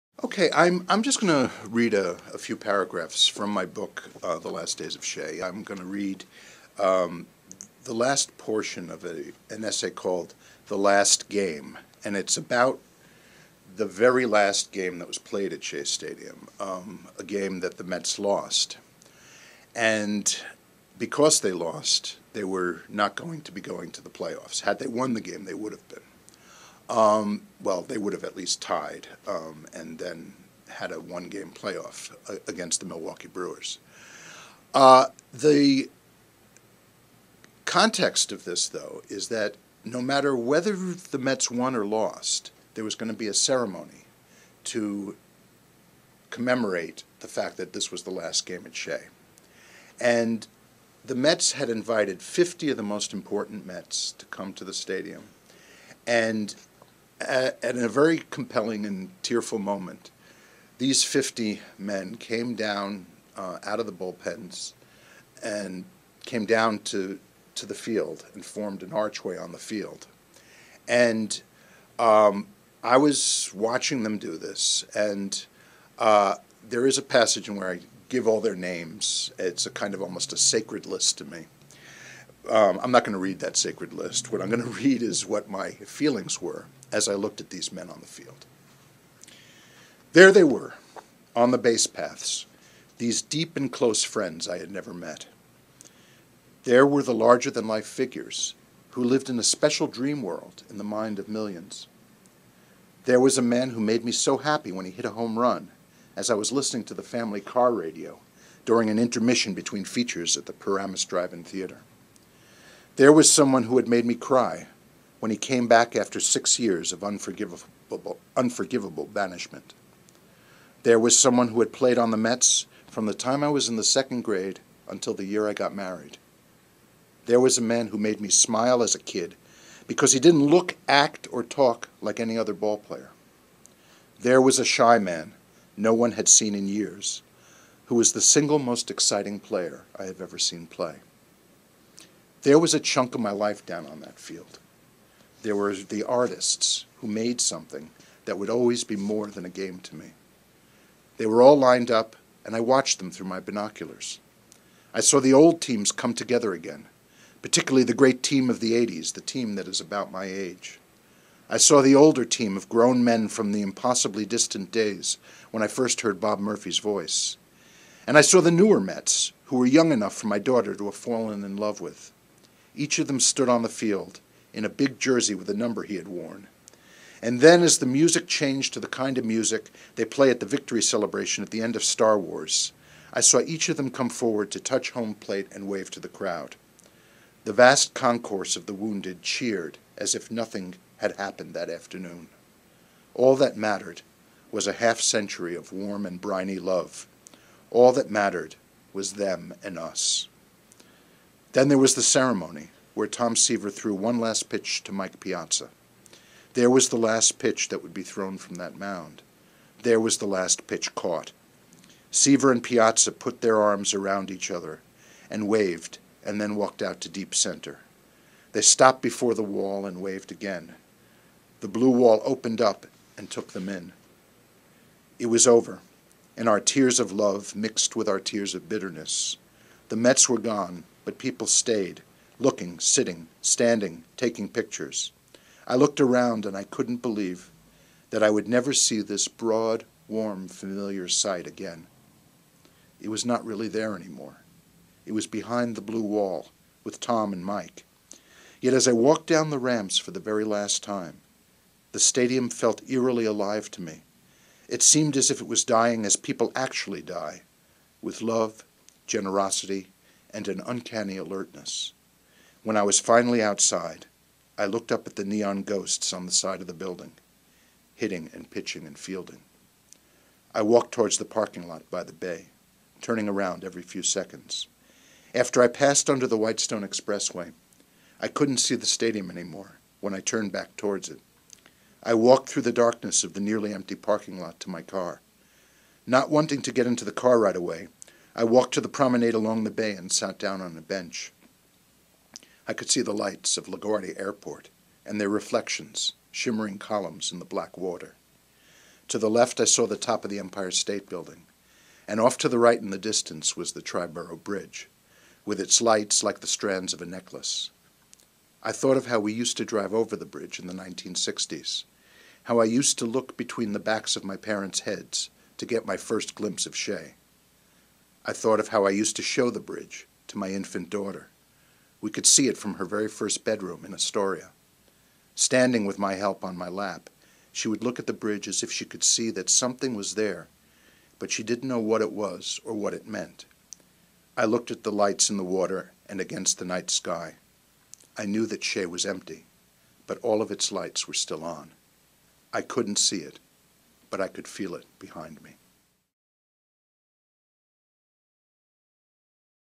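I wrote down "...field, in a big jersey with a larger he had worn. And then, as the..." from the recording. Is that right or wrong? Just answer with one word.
wrong.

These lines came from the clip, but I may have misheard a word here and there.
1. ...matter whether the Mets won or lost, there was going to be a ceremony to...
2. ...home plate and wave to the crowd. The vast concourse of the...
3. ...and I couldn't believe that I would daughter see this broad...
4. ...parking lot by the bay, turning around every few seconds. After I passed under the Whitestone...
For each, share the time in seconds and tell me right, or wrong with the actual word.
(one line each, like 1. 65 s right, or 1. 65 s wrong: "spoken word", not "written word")
1. 40 s right
2. 184 s right
3. 236 s wrong: "never", not "daughter"
4. 271 s right.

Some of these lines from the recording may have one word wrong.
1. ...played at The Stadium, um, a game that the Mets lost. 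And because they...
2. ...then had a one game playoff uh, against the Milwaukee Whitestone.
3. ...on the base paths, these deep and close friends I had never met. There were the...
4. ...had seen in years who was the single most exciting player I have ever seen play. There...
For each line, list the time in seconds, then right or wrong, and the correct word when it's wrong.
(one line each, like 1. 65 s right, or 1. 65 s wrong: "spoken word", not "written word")
1. 15 s wrong: "Shea", not "The"
2. 29 s wrong: "Brewers", not "Whitestone"
3. 91 s right
4. 136 s right.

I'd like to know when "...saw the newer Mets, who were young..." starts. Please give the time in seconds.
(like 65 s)
168 s.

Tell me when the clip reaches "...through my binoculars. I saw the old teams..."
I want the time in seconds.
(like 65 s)
153 s.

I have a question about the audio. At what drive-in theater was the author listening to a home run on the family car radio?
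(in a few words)
Paramus Drive In Theater.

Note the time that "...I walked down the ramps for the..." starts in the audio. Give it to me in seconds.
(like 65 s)
248 s.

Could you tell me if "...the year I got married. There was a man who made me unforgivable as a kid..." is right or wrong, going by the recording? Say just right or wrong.
wrong.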